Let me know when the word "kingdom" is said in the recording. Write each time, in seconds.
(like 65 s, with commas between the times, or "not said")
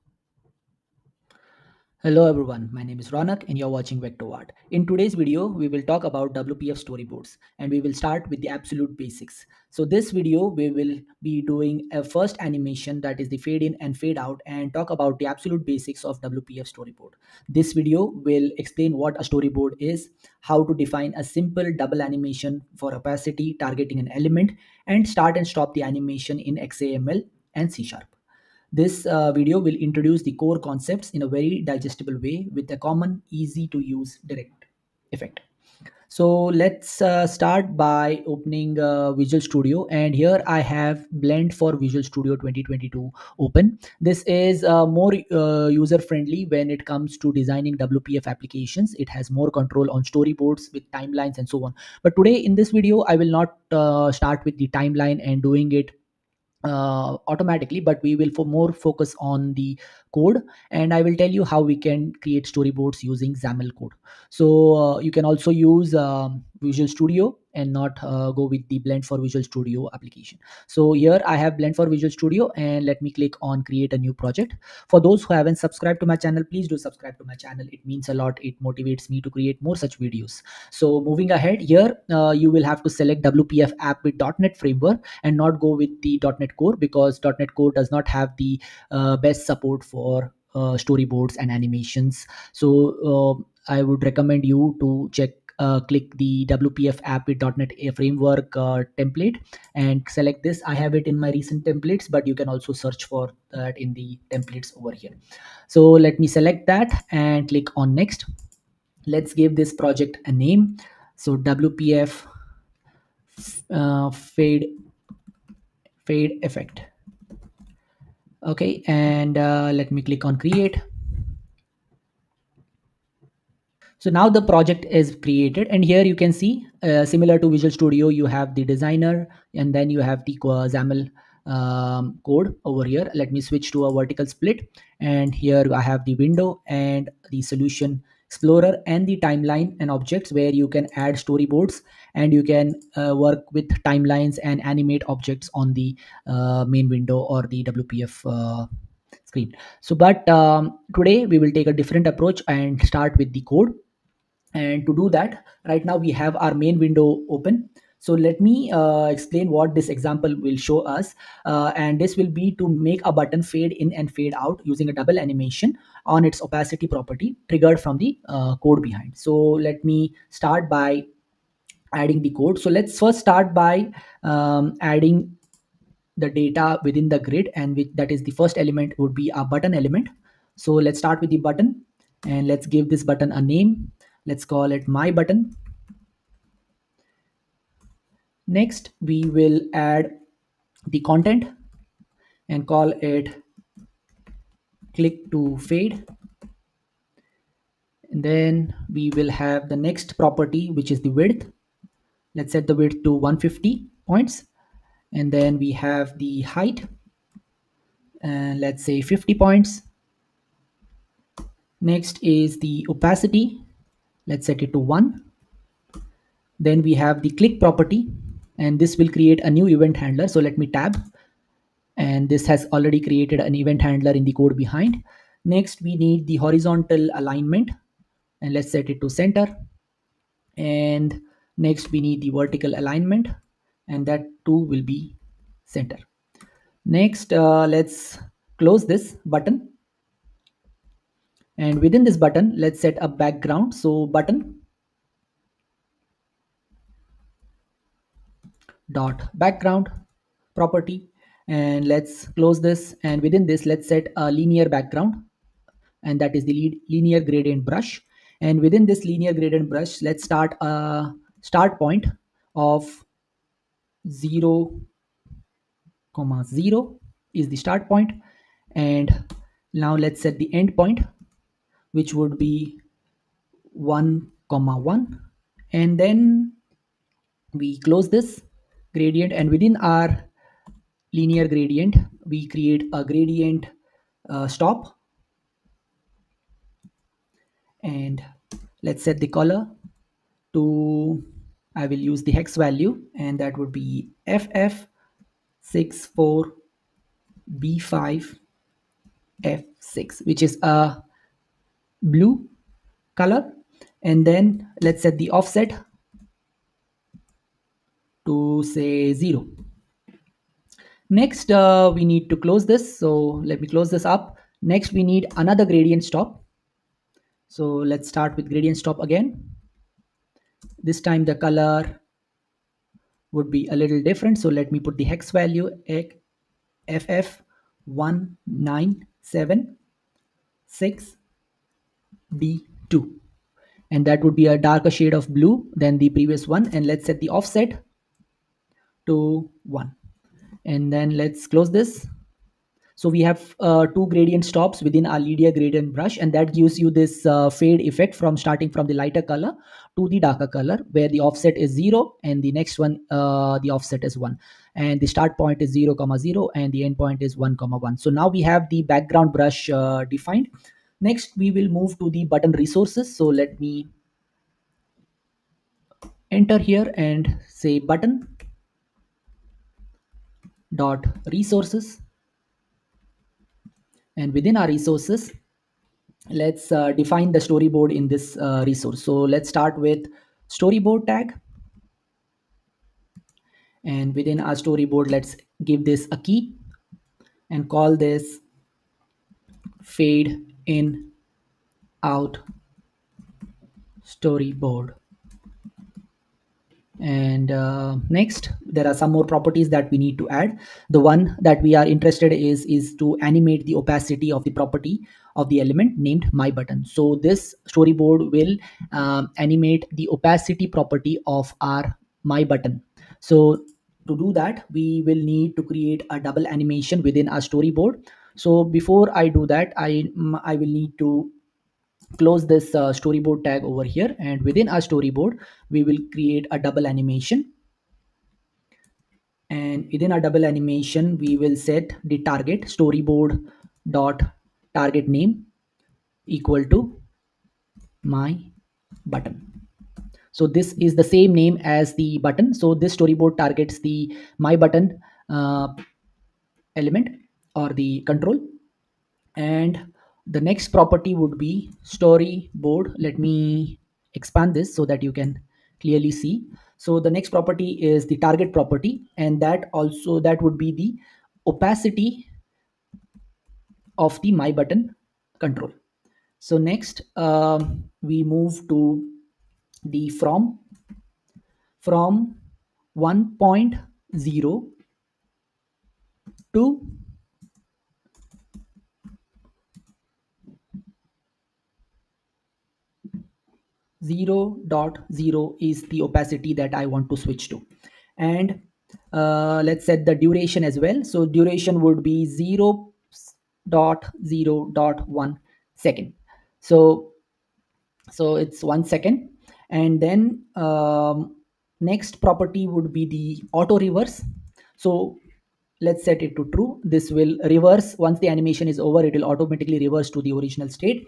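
not said.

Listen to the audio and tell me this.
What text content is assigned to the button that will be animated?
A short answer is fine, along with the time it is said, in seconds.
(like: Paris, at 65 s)
Click to fade, at 194 s.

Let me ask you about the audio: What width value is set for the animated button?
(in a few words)
150.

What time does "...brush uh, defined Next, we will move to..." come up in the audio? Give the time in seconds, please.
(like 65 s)
359 s.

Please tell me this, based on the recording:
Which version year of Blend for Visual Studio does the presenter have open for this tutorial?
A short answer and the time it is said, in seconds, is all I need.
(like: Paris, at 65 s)
2022, at 42 s.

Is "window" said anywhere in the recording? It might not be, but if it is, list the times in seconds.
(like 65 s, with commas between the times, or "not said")
136 s, 146 s, 156 s.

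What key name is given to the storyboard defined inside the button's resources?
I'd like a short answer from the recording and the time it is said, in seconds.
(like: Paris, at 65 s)
fade in out storyboard, at 389 s.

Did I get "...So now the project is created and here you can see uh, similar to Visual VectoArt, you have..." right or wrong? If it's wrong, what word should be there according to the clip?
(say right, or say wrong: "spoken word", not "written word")
wrong: "Studio", not "VectoArt".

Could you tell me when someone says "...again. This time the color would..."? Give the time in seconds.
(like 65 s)
318 s.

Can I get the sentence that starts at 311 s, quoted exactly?
Next, uh, we need to close this.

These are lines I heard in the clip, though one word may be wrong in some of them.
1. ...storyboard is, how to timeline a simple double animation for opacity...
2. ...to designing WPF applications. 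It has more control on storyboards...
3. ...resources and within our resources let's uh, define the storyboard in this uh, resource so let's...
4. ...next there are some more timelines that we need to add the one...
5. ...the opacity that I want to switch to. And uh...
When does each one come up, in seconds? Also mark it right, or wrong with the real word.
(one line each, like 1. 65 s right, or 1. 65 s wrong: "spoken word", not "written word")
1. 19 s wrong: "define", not "timeline"
2. 47 s right
3. 371 s right
4. 398 s wrong: "properties", not "timelines"
5. 485 s right.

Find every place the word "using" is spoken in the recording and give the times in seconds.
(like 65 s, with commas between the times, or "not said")
63 s, 164 s.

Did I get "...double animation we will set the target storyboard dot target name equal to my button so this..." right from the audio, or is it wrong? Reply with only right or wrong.
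right.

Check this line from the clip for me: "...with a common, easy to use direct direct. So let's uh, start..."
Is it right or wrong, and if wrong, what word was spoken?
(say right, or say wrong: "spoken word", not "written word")
wrong: "effect", not "direct".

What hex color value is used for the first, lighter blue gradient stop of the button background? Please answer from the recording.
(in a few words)
FF64B5F6.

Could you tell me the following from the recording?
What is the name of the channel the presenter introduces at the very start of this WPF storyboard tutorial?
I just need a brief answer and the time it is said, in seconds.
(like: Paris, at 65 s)
VectoArt, at 4 s.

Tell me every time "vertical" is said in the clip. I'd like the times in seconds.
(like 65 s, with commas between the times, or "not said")
133 s, 232 s.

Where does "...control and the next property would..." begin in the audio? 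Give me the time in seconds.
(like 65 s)
448 s.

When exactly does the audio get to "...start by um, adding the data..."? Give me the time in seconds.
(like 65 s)
173 s.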